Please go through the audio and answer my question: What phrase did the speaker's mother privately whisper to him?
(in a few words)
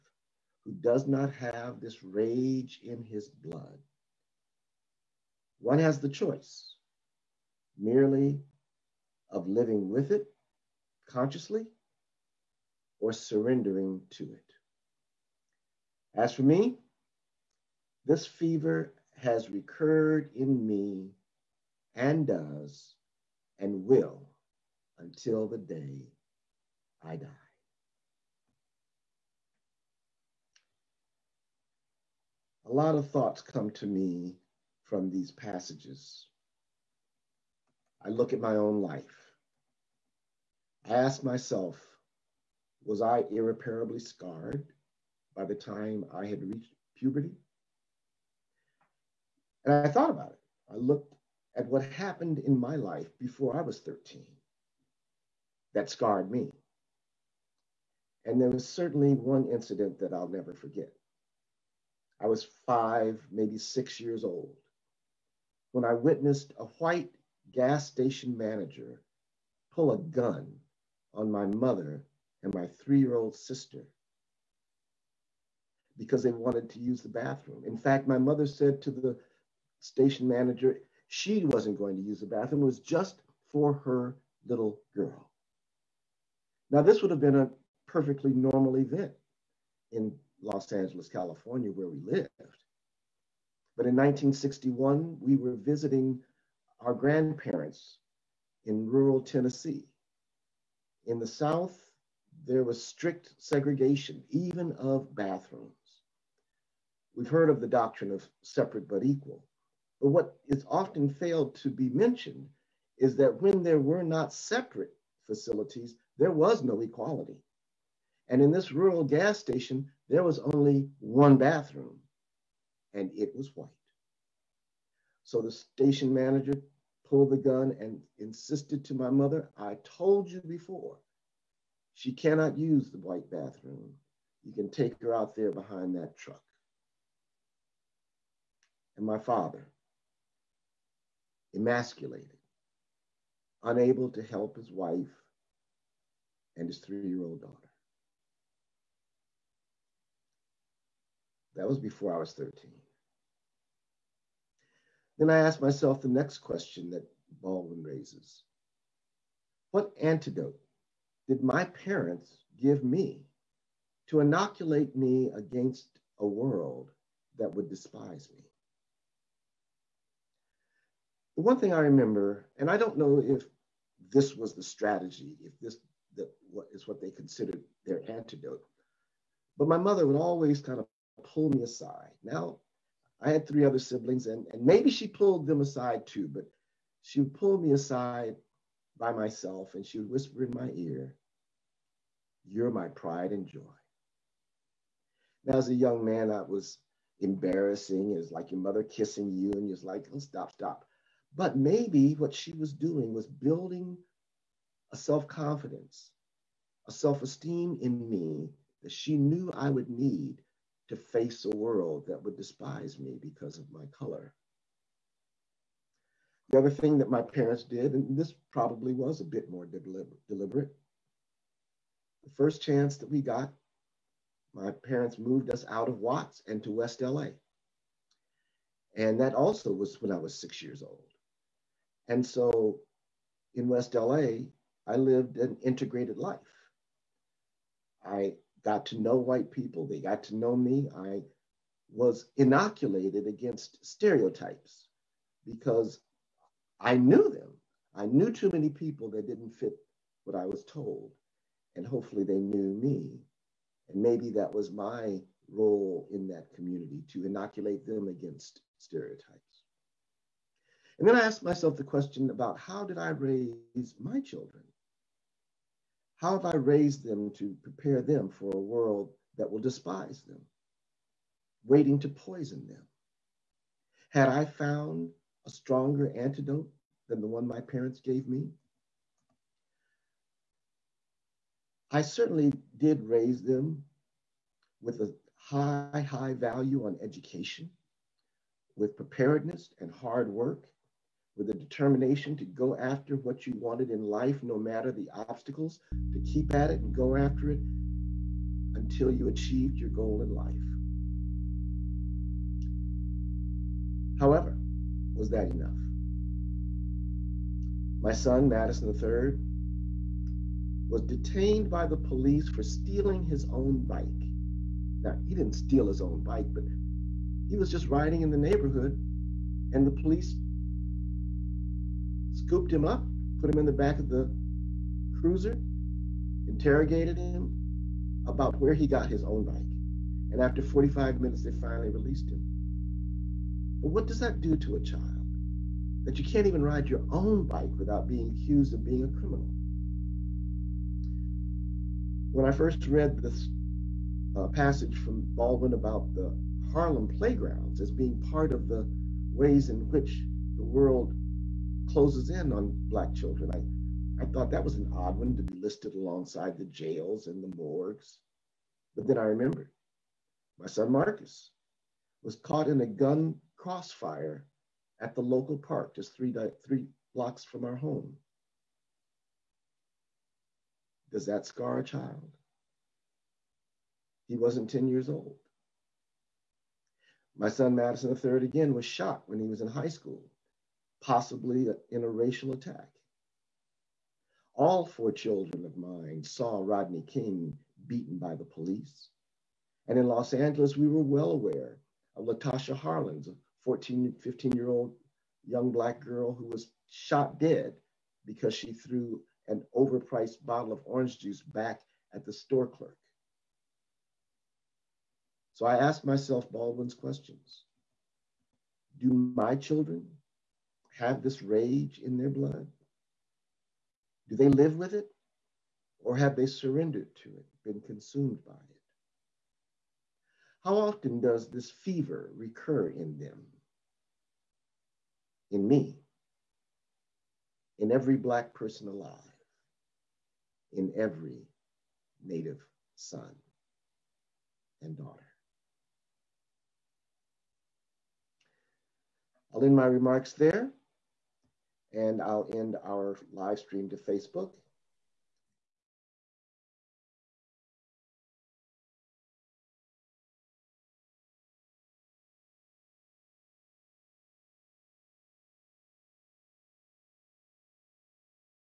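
You're my pride and joy.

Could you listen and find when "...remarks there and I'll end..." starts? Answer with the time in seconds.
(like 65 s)
439 s.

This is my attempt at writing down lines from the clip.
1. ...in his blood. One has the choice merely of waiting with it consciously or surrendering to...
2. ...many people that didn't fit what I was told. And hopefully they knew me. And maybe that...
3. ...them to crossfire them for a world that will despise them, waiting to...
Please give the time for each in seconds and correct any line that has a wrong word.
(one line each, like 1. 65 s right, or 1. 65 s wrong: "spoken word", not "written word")
1. 2 s wrong: "living", not "waiting"
2. 248 s right
3. 267 s wrong: "prepare", not "crossfire".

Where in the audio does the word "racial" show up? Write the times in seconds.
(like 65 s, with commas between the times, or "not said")
382 s.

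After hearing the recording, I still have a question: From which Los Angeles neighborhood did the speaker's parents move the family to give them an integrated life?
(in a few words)
Watts.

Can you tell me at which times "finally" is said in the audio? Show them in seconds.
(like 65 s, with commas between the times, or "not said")
331 s.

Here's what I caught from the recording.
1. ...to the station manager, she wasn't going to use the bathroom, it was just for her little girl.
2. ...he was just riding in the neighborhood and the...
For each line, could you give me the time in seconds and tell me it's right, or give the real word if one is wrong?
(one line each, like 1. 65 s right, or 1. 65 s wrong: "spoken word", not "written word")
1. 78 s right
2. 317 s right.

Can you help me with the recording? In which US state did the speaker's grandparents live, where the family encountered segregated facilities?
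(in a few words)
Tennessee.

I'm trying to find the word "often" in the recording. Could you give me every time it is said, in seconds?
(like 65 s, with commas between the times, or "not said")
110 s, 420 s.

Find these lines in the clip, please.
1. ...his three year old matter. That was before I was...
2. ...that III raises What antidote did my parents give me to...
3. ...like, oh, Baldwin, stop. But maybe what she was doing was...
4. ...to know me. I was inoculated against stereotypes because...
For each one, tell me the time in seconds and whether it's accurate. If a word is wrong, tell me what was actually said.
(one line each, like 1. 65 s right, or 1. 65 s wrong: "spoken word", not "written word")
1. 146 s wrong: "daughter", not "matter"
2. 156 s wrong: "Baldwin", not "III"
3. 199 s wrong: "Stop", not "Baldwin"
4. 240 s right.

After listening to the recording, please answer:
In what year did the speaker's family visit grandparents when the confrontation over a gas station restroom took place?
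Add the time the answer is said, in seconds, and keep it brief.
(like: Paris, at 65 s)
1961, at 93 s.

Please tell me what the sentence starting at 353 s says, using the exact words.
I, I thought that was an odd one to be listed alongside the jails and the morgues.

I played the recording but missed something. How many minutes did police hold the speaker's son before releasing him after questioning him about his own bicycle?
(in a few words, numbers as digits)
45.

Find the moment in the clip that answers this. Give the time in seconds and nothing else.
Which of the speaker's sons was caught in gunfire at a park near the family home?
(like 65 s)
360 s.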